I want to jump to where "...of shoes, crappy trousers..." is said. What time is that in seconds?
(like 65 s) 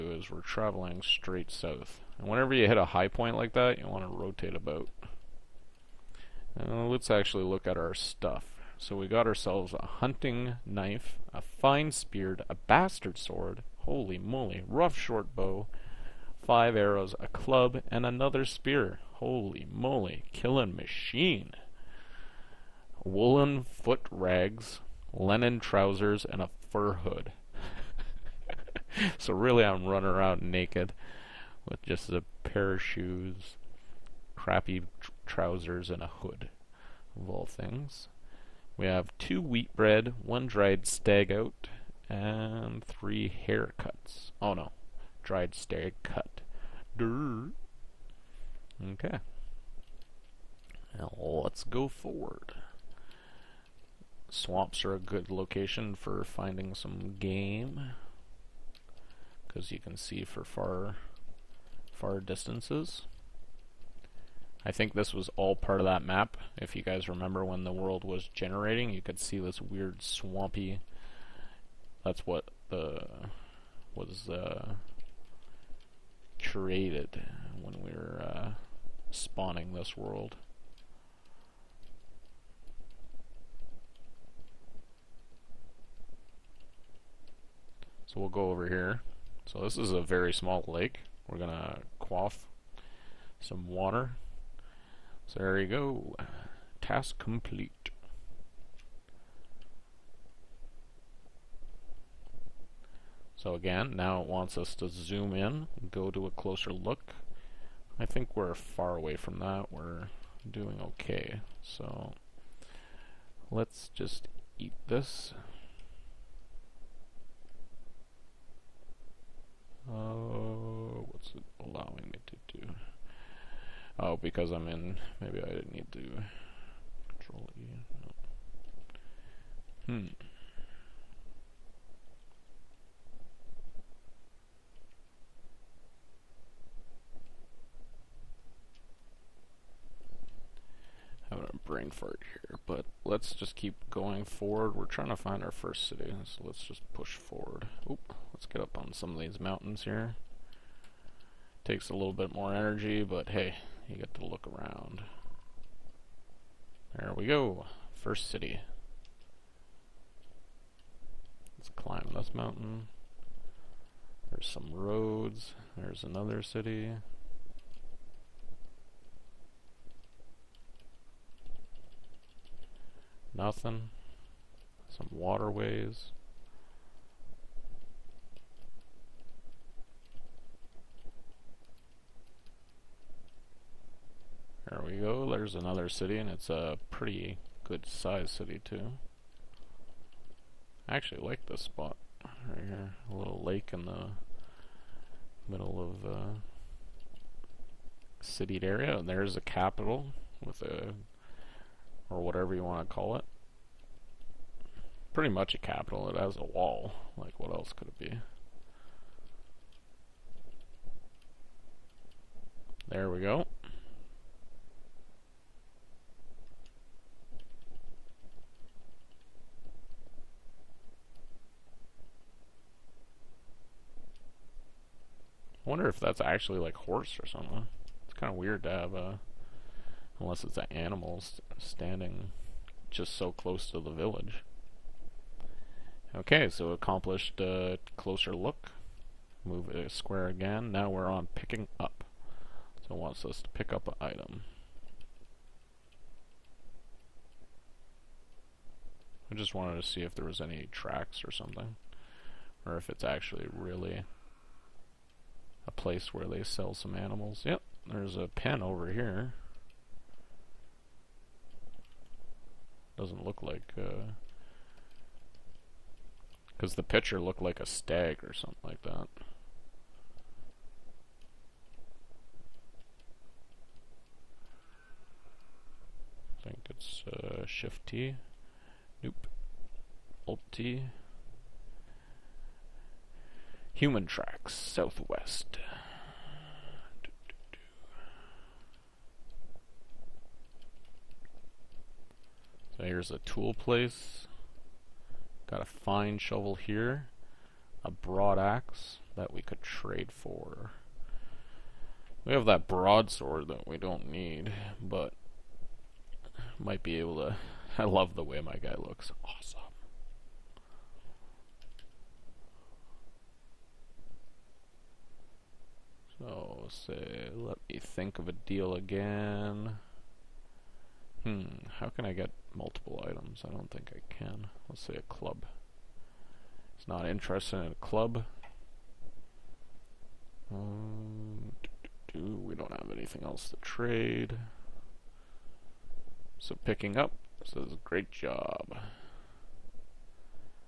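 32 s.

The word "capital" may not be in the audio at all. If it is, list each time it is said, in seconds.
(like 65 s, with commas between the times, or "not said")
199 s, 205 s.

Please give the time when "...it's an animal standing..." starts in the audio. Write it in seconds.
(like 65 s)
230 s.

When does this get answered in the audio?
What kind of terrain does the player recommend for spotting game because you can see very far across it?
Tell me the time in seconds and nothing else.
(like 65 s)
54 s.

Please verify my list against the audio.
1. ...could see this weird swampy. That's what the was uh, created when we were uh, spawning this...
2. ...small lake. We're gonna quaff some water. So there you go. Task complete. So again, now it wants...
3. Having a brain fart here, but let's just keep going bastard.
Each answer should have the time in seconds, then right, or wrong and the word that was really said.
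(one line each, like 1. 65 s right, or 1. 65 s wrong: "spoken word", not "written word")
1. 68 s right
2. 90 s right
3. 141 s wrong: "forward", not "bastard".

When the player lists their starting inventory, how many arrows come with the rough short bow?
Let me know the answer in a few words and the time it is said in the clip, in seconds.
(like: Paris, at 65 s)
5, at 16 s.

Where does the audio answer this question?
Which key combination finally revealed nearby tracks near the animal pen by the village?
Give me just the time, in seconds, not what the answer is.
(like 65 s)
280 s.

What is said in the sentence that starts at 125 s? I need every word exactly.
Maybe I didn't need to control E.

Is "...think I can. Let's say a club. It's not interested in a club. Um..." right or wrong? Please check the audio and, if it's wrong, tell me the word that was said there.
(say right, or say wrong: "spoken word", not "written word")
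right.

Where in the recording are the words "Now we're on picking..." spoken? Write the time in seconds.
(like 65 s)
240 s.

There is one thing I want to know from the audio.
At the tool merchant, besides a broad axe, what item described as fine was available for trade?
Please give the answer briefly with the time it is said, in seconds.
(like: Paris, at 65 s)
Fine shovel, at 295 s.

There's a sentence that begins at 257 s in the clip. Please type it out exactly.
Yep, there's a pen over here.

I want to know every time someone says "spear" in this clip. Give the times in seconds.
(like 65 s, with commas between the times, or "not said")
11 s, 18 s.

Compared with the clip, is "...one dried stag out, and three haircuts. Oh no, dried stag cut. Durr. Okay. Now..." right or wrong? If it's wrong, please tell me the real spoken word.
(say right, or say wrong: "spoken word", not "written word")
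right.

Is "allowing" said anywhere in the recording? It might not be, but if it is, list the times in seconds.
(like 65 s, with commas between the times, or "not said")
121 s.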